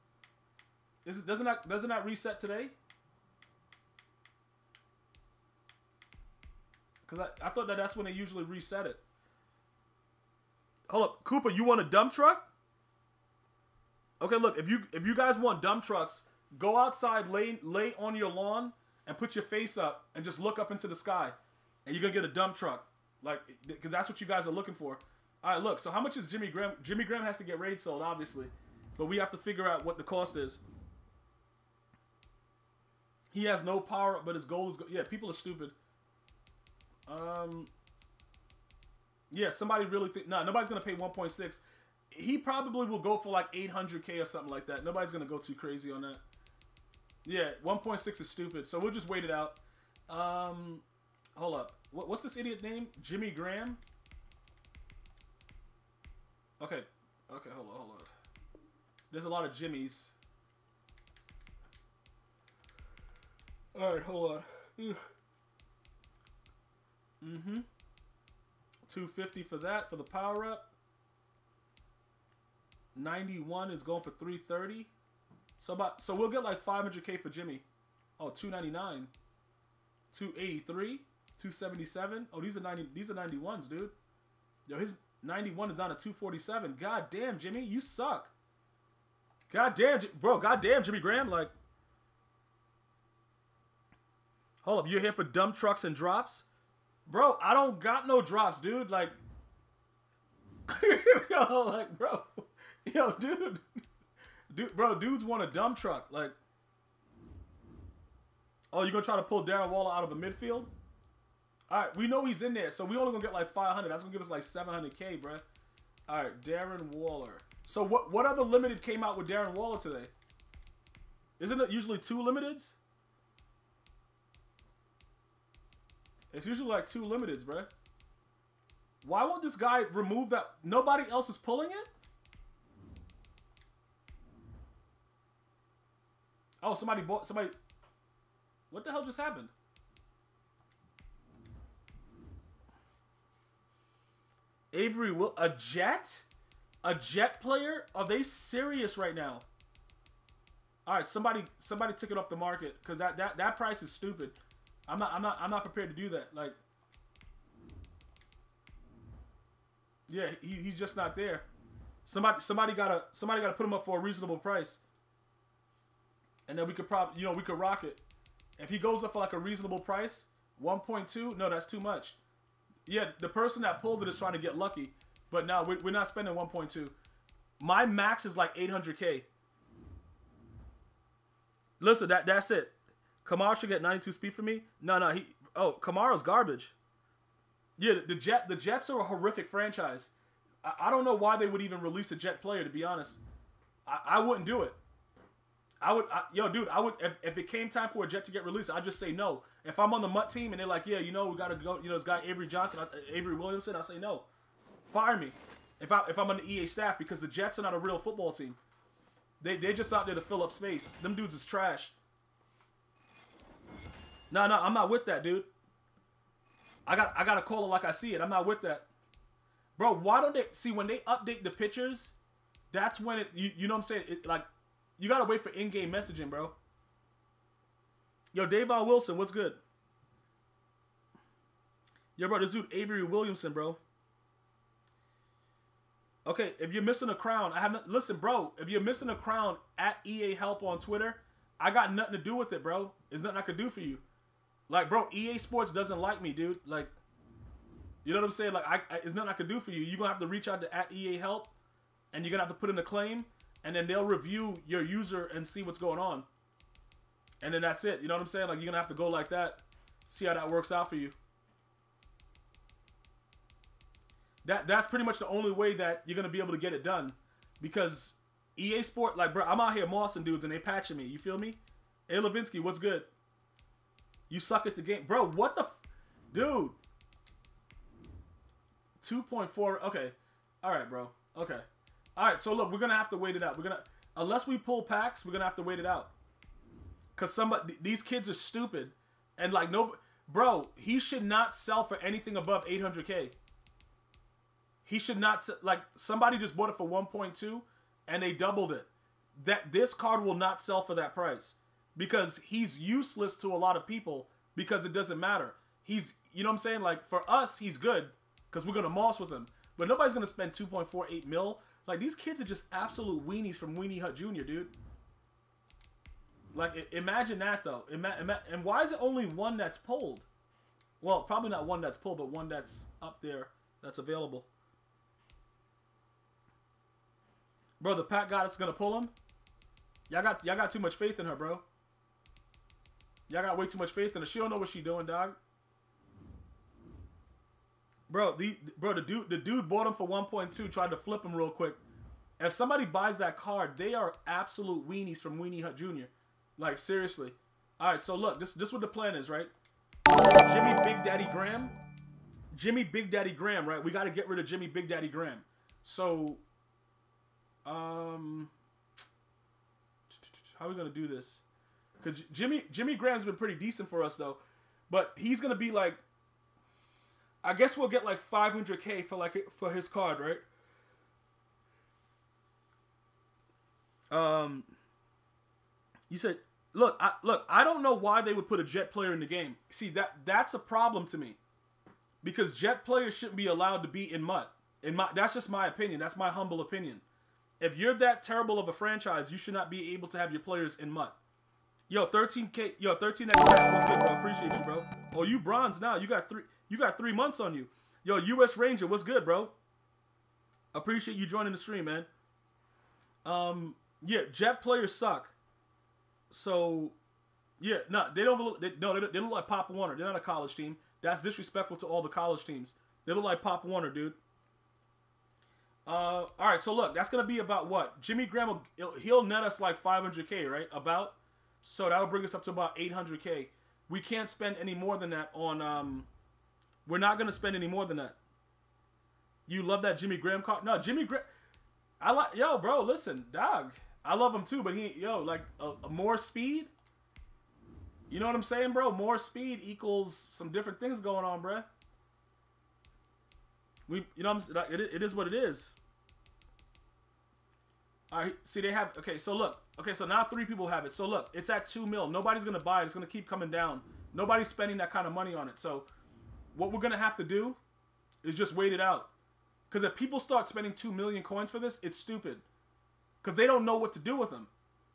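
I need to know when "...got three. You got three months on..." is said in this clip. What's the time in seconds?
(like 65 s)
396 s.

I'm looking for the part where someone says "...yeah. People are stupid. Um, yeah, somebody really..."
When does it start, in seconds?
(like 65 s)
34 s.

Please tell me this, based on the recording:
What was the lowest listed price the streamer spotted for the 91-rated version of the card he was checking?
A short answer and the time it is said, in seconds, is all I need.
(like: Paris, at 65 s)
247, at 85 s.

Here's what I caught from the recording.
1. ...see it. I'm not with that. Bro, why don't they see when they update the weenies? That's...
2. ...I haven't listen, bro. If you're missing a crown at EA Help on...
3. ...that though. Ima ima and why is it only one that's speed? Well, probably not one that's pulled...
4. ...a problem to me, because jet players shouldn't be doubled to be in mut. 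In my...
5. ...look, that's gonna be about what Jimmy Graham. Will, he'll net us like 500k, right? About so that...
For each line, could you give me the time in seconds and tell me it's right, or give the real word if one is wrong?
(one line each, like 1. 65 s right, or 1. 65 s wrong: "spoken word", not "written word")
1. 217 s wrong: "pictures", not "weenies"
2. 237 s right
3. 317 s wrong: "pulled", not "speed"
4. 380 s wrong: "allowed", not "doubled"
5. 416 s right.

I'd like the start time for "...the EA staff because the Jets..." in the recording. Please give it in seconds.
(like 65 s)
206 s.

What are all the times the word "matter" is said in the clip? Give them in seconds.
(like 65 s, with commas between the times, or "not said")
305 s.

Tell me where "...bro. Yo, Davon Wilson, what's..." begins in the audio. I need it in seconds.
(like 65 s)
226 s.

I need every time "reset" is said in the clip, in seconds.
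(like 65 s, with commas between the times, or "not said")
2 s, 8 s.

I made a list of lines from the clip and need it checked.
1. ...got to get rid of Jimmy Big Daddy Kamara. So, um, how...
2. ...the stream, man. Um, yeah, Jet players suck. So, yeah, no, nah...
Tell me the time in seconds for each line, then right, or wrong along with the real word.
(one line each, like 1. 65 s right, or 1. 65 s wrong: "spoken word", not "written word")
1. 353 s wrong: "Graham", not "Kamara"
2. 401 s right.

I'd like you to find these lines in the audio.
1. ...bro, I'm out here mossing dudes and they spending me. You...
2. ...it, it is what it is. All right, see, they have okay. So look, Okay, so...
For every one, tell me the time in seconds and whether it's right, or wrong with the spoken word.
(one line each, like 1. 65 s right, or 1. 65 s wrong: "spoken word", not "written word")
1. 269 s wrong: "patching", not "spending"
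2. 444 s right.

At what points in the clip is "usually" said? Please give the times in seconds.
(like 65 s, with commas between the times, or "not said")
8 s, 121 s, 126 s.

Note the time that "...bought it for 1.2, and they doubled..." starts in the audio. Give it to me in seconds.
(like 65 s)
296 s.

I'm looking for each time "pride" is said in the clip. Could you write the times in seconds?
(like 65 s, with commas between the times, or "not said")
not said.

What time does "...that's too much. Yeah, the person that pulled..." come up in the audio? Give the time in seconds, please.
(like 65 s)
171 s.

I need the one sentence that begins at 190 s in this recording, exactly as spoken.
I, I don't know why they would even release a Jet player.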